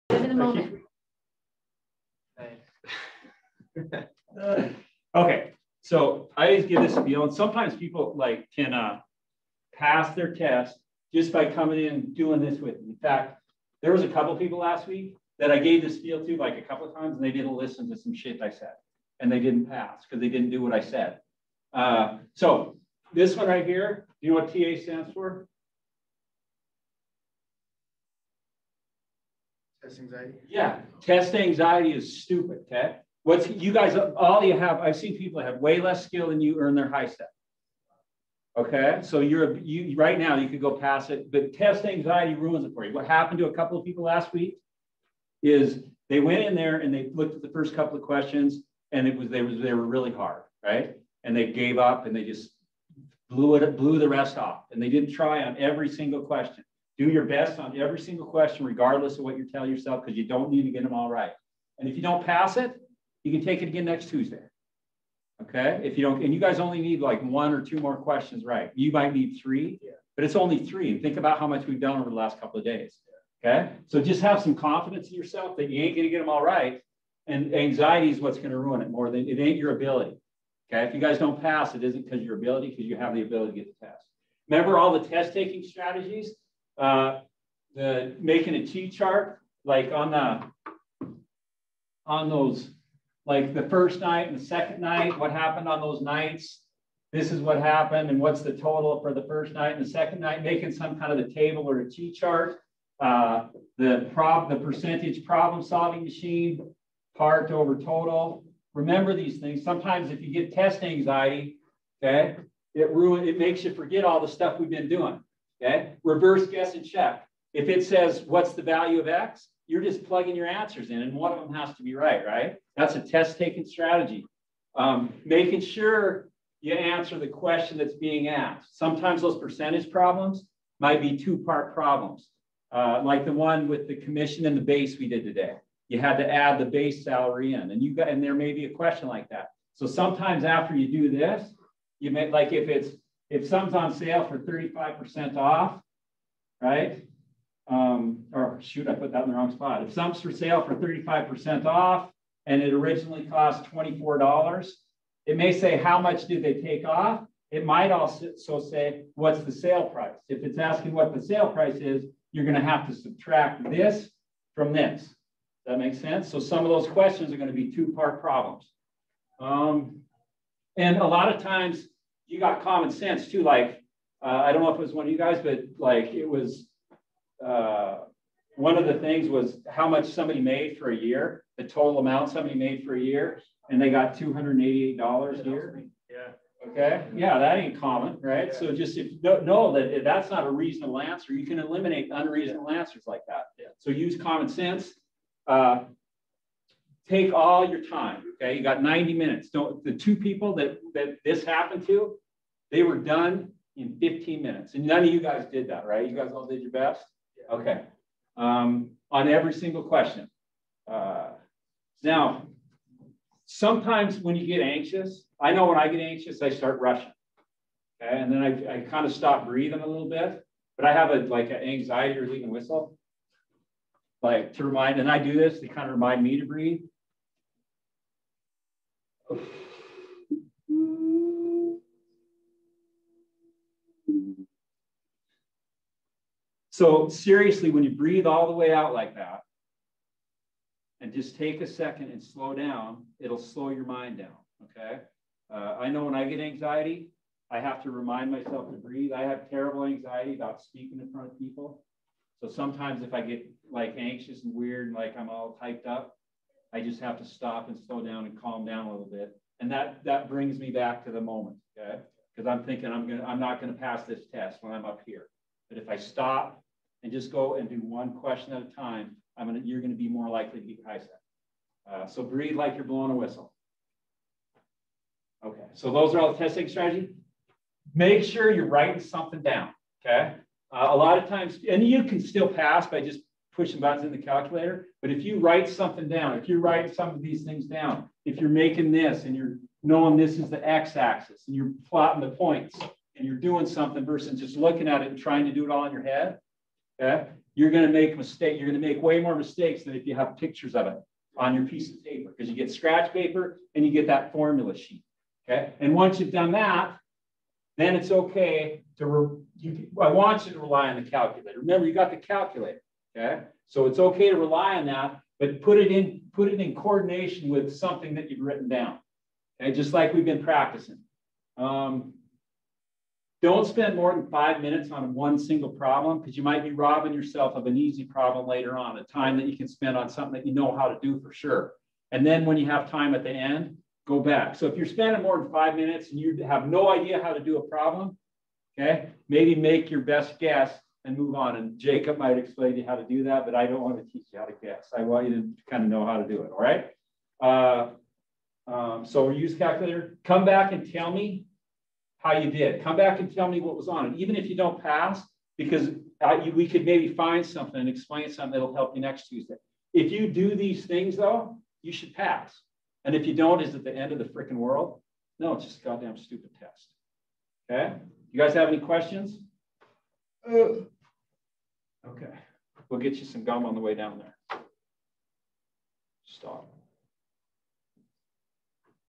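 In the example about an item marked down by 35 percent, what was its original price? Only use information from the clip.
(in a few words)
$24.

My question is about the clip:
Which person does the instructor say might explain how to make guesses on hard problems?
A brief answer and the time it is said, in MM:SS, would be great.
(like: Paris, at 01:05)
Jacob, at 05:41.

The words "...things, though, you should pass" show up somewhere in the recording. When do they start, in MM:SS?
06:00.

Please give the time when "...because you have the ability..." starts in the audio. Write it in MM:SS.
01:22.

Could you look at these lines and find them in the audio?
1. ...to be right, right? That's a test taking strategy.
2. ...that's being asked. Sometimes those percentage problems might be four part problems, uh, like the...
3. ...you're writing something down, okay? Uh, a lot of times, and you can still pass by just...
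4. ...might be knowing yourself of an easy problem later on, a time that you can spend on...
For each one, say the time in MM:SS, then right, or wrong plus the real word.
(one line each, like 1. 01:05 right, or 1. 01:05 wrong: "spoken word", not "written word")
1. 02:01 right
2. 02:07 wrong: "two", not "four"
3. 04:38 right
4. 05:26 wrong: "robbing", not "knowing".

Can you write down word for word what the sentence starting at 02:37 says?
It might also say, what's the sale price?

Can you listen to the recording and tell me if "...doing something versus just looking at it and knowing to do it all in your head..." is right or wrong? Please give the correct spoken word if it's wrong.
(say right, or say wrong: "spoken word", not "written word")
wrong: "trying", not "knowing".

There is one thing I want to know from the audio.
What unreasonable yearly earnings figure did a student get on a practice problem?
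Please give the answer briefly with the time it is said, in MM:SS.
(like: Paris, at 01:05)
$288, at 03:04.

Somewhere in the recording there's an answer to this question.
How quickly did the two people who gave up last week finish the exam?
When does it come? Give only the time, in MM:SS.
03:23.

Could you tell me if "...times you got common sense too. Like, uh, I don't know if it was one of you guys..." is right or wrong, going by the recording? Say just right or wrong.
right.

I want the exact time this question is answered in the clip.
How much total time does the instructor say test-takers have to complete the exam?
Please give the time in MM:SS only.
03:18.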